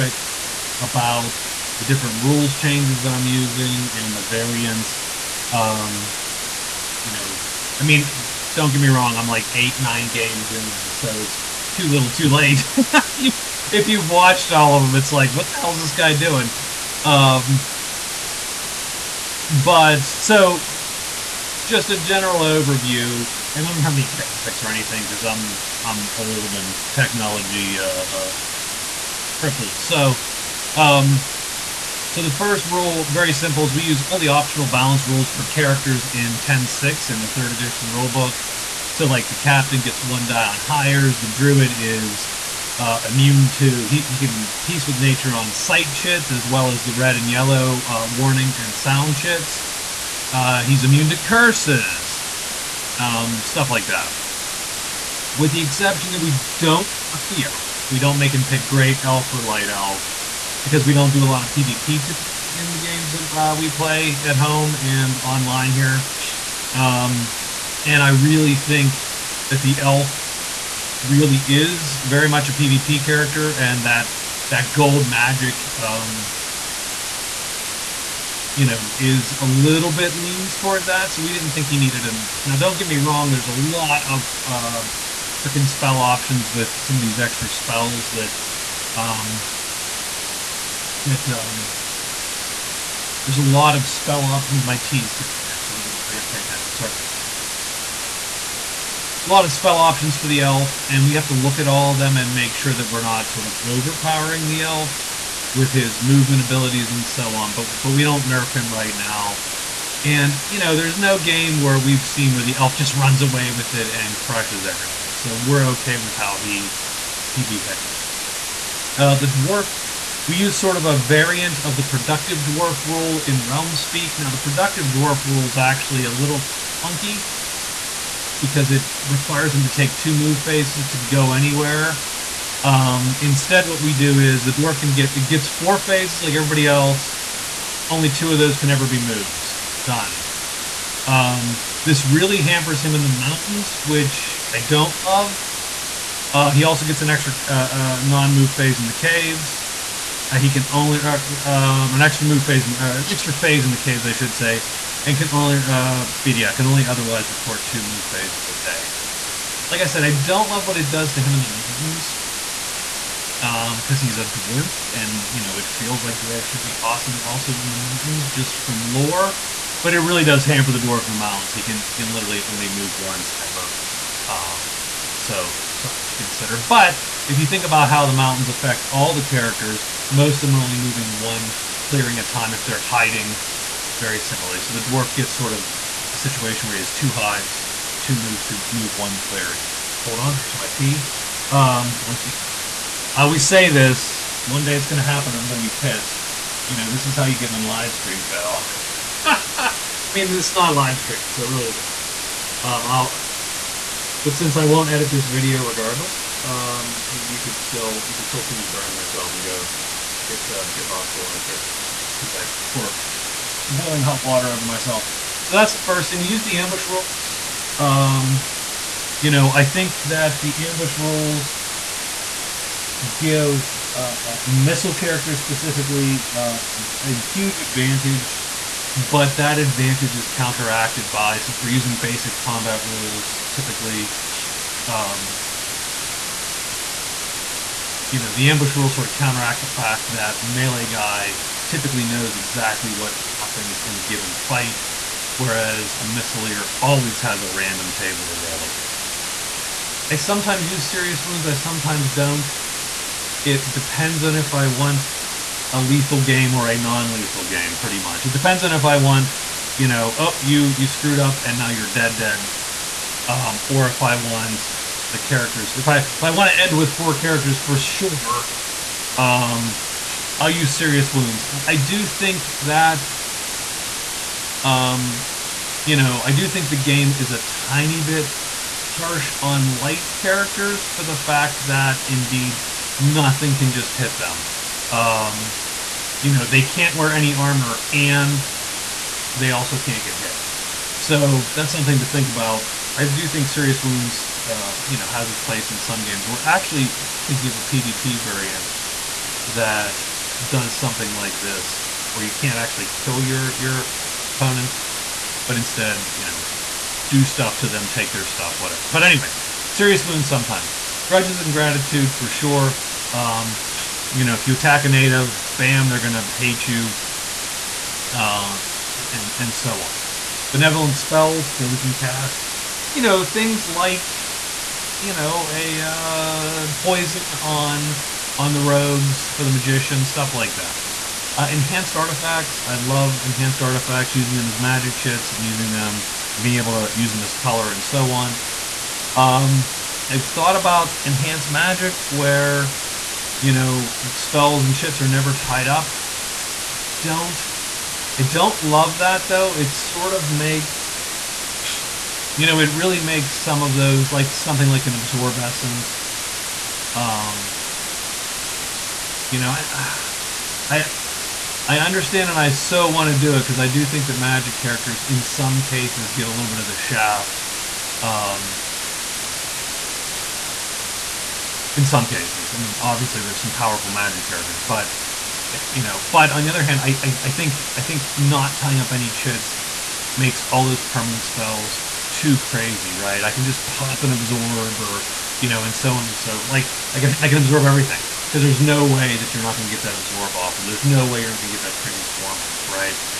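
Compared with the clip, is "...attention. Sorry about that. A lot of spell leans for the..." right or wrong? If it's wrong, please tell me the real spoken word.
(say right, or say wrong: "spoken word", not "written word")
wrong: "options", not "leans".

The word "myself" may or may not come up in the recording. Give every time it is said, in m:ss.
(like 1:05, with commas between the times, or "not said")
3:28, 3:34.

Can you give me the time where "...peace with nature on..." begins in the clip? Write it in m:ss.
0:44.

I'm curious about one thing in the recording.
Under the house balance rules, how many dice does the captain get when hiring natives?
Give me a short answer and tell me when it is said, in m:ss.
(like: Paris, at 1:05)
1, at 0:40.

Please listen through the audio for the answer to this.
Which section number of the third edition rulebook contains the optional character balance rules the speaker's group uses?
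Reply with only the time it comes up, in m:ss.
0:36.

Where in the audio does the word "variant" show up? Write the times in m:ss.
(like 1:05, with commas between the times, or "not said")
0:04, 2:00, 4:58.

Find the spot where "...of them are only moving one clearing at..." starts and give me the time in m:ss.
3:00.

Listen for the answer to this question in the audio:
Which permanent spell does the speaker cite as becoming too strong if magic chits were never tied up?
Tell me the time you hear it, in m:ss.
5:54.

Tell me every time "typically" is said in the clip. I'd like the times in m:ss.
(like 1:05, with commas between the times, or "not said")
1:02, 3:53, 4:01.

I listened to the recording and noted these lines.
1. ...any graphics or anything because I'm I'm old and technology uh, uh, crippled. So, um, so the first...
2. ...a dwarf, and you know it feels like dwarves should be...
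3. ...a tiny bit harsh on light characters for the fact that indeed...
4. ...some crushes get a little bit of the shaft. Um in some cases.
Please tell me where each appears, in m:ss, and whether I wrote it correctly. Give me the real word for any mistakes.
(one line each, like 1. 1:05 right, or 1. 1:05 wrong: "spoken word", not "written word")
1. 0:23 right
2. 2:44 right
3. 4:37 right
4. 6:05 wrong: "cases", not "crushes".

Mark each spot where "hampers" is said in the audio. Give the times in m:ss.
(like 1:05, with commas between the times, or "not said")
2:22, 2:50.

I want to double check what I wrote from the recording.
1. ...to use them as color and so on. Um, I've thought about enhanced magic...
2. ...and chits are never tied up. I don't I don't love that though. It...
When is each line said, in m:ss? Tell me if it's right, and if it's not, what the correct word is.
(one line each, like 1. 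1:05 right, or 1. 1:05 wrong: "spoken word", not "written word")
1. 5:36 right
2. 5:44 right.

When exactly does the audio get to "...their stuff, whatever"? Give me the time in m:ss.
5:08.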